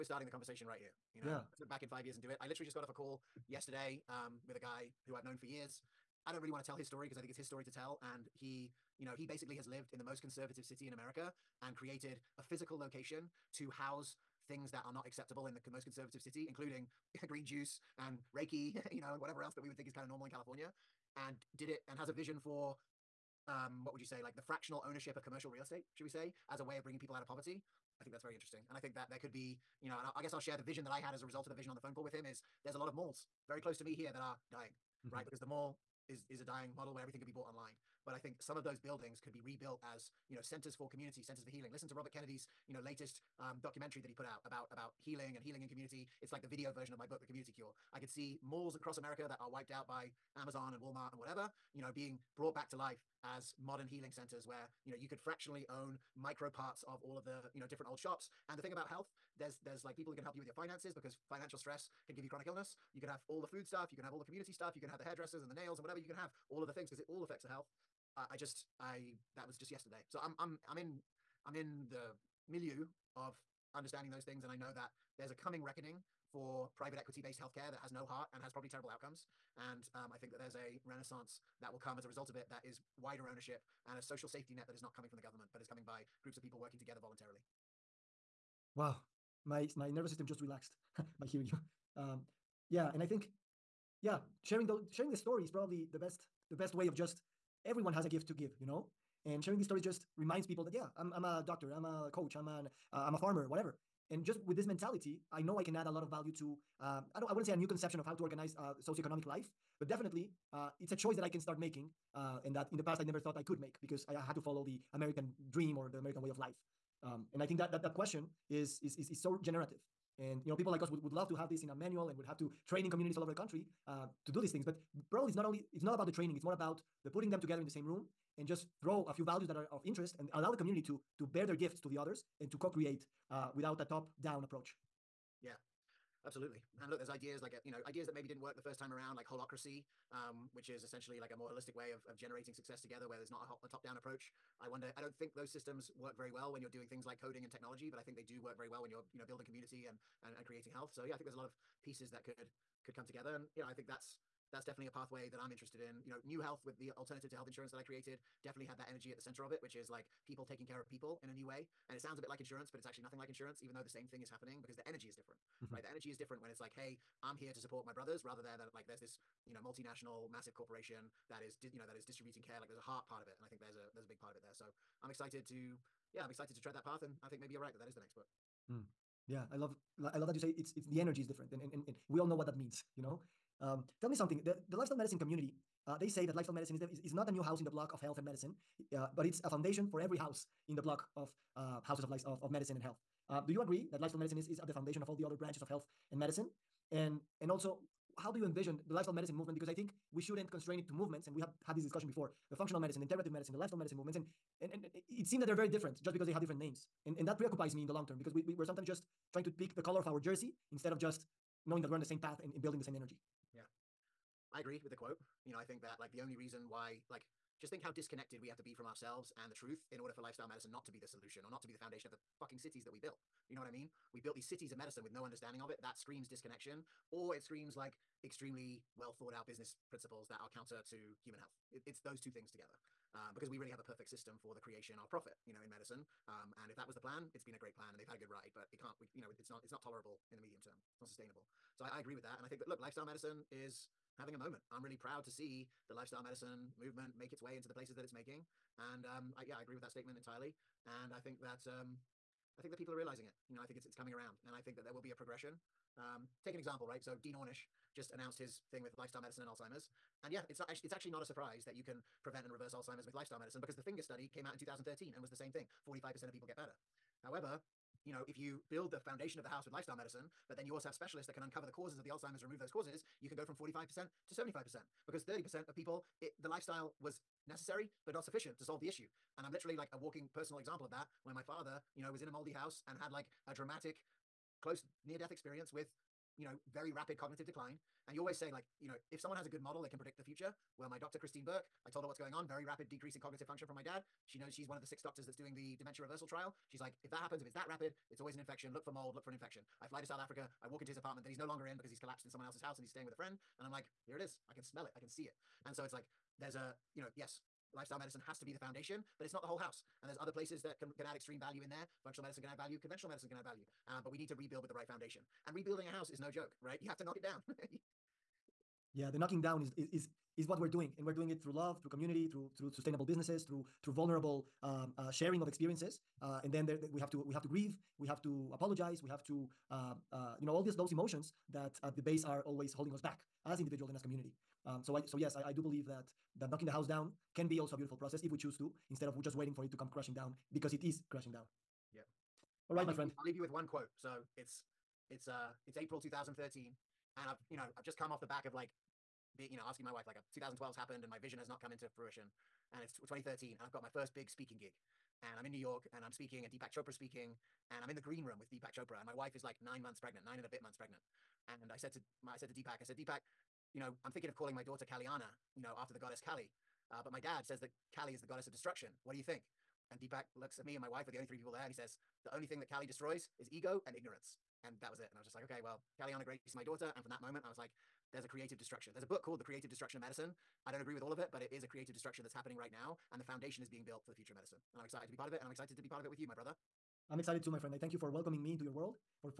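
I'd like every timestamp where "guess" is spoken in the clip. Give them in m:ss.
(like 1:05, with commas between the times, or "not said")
0:30.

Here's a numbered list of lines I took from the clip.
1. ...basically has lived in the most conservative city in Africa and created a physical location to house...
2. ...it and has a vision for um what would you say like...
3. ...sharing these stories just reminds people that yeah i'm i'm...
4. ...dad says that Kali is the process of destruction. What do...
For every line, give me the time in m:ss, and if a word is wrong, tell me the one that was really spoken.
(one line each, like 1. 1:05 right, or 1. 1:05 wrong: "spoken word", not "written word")
1. 0:09 wrong: "America", not "Africa"
2. 0:21 right
3. 1:39 right
4. 6:07 wrong: "goddess", not "process".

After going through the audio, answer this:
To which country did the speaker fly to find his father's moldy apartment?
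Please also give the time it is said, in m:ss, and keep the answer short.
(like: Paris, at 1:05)
South Africa, at 5:00.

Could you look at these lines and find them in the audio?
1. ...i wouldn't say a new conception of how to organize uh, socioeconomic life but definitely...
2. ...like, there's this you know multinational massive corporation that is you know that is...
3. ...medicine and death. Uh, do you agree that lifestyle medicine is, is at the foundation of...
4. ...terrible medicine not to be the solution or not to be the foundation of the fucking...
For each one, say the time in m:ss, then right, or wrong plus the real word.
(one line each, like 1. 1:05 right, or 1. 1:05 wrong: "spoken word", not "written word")
1. 1:47 right
2. 2:48 right
3. 3:12 wrong: "health", not "death"
4. 3:40 wrong: "lifestyle", not "terrible".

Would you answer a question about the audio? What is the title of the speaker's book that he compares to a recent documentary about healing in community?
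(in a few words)
The Community Cure.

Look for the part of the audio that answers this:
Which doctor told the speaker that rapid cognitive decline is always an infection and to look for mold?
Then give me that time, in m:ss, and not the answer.
4:51.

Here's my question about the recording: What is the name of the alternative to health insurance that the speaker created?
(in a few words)
Knew Health.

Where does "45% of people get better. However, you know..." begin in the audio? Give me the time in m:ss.
4:25.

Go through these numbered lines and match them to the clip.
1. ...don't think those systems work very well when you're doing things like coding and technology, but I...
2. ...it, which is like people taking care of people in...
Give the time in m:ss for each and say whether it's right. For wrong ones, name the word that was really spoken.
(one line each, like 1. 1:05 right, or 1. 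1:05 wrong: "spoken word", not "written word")
1. 2:25 right
2. 2:39 right.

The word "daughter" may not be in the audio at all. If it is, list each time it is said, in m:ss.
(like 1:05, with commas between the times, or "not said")
6:04, 6:16.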